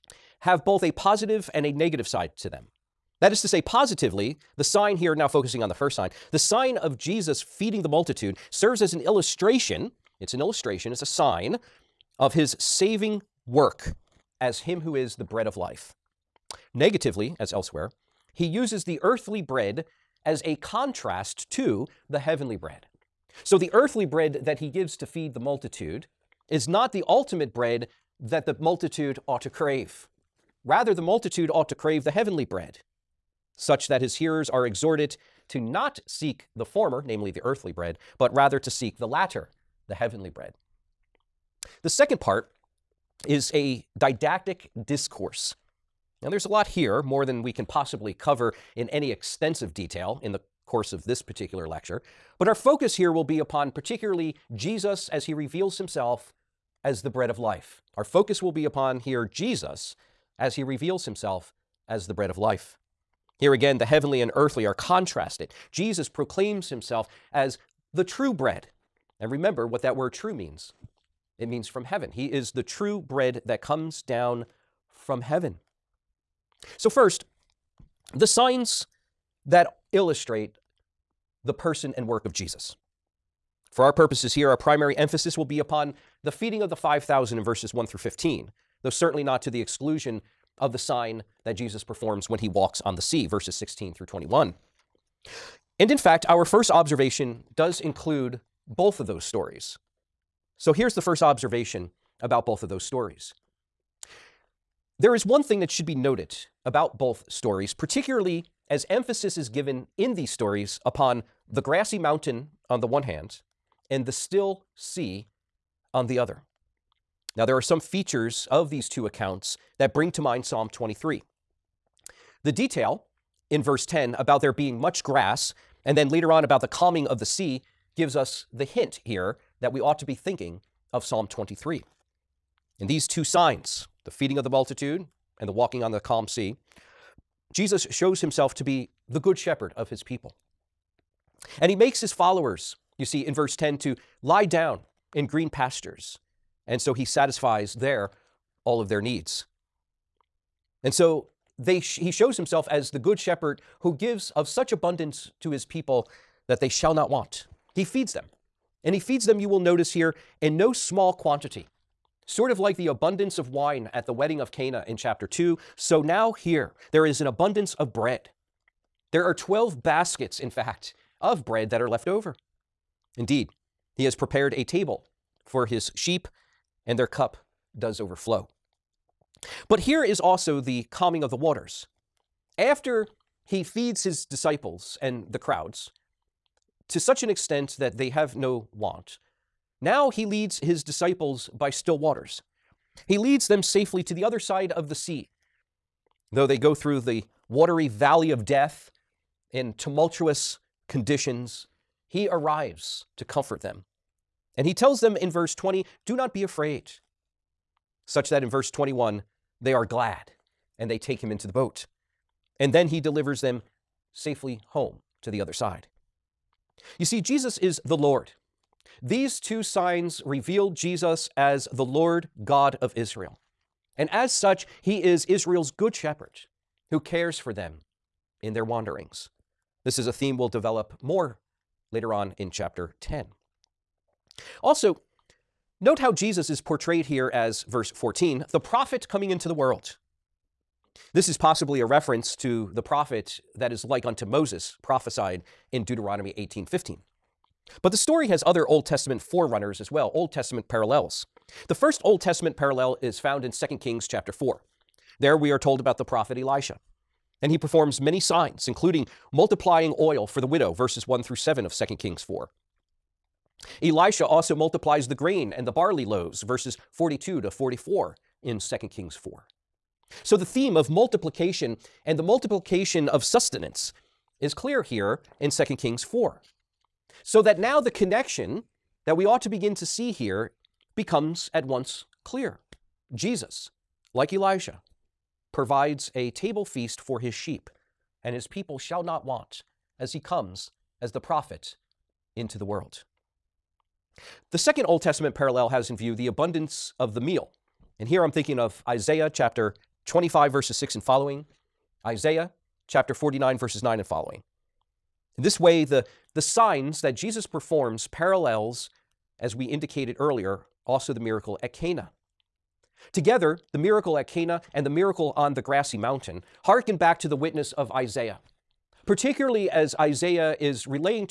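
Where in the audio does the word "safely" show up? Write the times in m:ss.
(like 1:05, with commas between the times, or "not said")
3:13, 3:34.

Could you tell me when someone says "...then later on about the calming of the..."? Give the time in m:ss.
2:05.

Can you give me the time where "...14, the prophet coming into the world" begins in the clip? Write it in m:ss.
3:57.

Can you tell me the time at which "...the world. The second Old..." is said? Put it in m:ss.
4:52.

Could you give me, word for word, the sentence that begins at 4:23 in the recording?
Elisha also multiplies the grain and the barley loaves, verses 42 to 44 in 2 Kings 4.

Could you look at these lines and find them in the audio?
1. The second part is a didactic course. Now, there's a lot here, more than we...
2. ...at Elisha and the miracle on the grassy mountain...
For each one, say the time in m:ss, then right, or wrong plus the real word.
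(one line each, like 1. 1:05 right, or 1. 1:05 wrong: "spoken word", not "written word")
1. 0:41 wrong: "discourse", not "course"
2. 5:14 wrong: "Cana", not "Elisha".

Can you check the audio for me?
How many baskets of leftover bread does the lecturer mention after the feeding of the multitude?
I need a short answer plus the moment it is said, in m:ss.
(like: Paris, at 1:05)
12, at 2:49.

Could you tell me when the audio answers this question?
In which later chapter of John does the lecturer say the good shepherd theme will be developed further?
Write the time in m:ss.
3:52.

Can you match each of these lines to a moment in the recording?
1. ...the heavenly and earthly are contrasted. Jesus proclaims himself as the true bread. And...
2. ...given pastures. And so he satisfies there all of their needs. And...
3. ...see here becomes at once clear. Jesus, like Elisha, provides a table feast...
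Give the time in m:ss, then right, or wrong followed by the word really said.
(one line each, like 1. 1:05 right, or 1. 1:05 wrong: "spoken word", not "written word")
1. 1:03 right
2. 2:25 wrong: "green", not "given"
3. 4:39 right.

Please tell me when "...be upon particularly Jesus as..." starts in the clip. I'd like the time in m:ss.
0:53.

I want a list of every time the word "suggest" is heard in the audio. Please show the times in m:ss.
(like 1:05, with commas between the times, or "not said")
not said.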